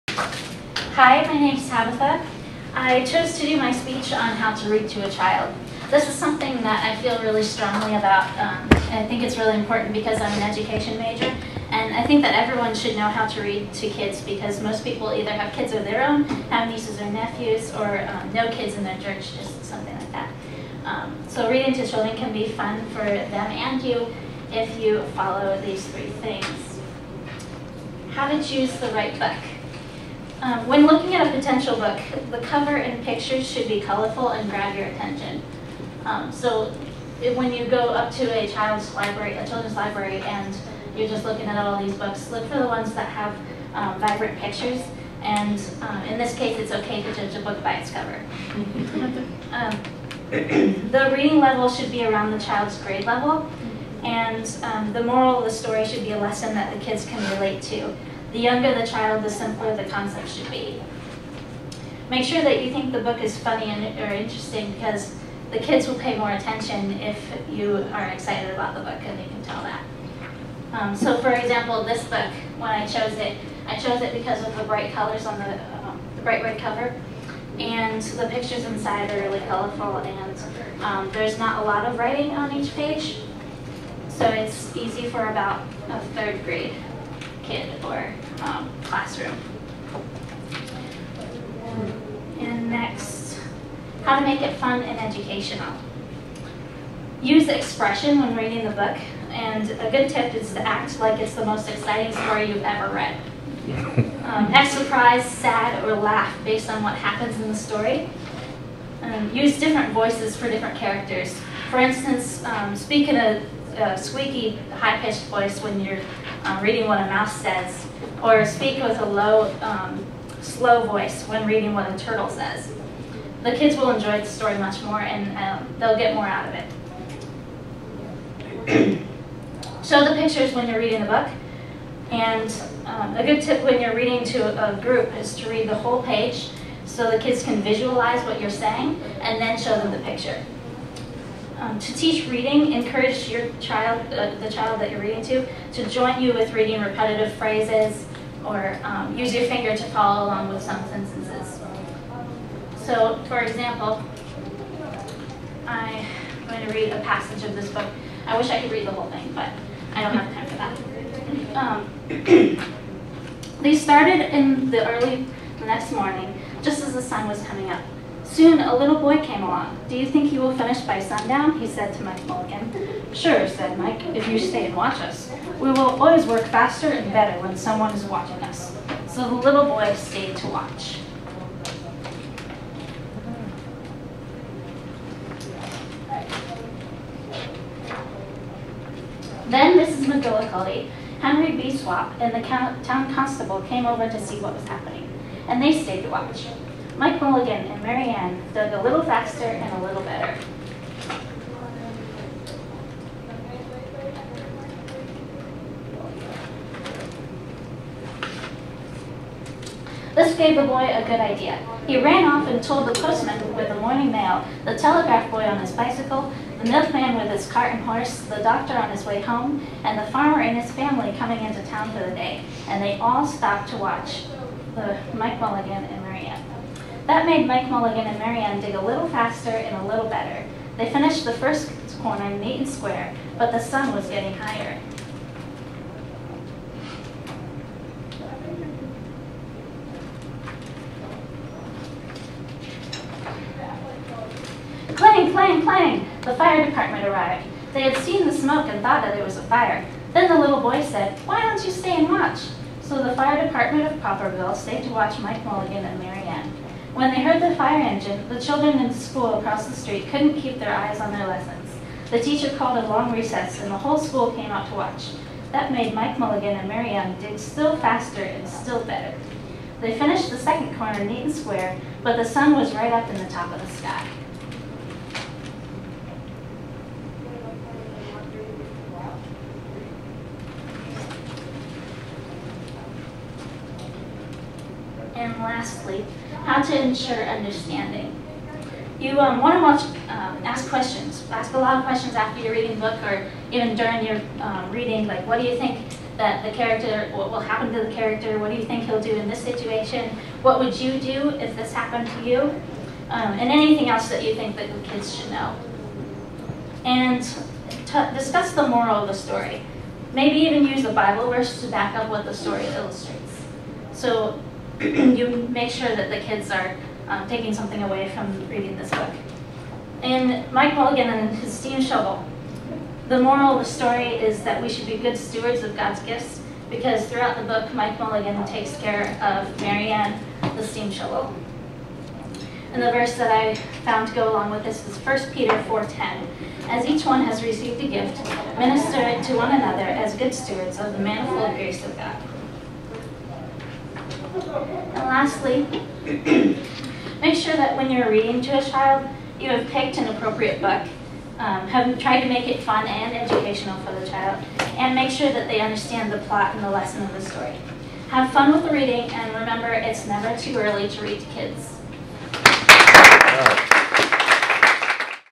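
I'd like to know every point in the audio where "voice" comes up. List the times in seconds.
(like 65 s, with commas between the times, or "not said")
109 s, 115 s, 120 s.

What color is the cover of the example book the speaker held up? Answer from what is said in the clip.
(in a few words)
Red.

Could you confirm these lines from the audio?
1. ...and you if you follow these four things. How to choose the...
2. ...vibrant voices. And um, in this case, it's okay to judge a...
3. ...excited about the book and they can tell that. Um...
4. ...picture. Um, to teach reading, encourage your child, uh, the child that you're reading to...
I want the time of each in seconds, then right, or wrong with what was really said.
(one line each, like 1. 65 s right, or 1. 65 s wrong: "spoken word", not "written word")
1. 23 s wrong: "three", not "four"
2. 44 s wrong: "pictures", not "voices"
3. 68 s right
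4. 139 s right.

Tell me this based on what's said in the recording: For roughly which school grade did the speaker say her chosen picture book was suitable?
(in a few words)
Third grade.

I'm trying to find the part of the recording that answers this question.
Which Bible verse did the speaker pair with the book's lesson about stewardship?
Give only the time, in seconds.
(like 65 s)
334 s.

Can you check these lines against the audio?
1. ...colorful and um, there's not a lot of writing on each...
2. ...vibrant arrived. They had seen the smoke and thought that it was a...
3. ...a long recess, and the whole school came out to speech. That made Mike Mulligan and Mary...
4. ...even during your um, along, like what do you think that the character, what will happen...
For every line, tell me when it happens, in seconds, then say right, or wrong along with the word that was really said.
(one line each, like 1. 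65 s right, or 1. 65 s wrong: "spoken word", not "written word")
1. 79 s right
2. 246 s wrong: "department", not "vibrant"
3. 262 s wrong: "watch", not "speech"
4. 293 s wrong: "reading", not "along".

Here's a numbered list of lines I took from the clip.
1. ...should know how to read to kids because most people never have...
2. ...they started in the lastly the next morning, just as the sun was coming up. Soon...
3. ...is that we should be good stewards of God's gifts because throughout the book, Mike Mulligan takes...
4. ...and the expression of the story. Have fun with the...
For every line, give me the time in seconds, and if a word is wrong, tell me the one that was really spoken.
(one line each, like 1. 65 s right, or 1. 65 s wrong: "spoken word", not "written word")
1. 12 s wrong: "either", not "never"
2. 163 s wrong: "early", not "lastly"
3. 324 s right
4. 356 s wrong: "lesson", not "expression".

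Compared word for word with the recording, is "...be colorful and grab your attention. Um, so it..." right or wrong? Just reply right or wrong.
right.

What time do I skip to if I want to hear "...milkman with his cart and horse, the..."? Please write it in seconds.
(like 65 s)
216 s.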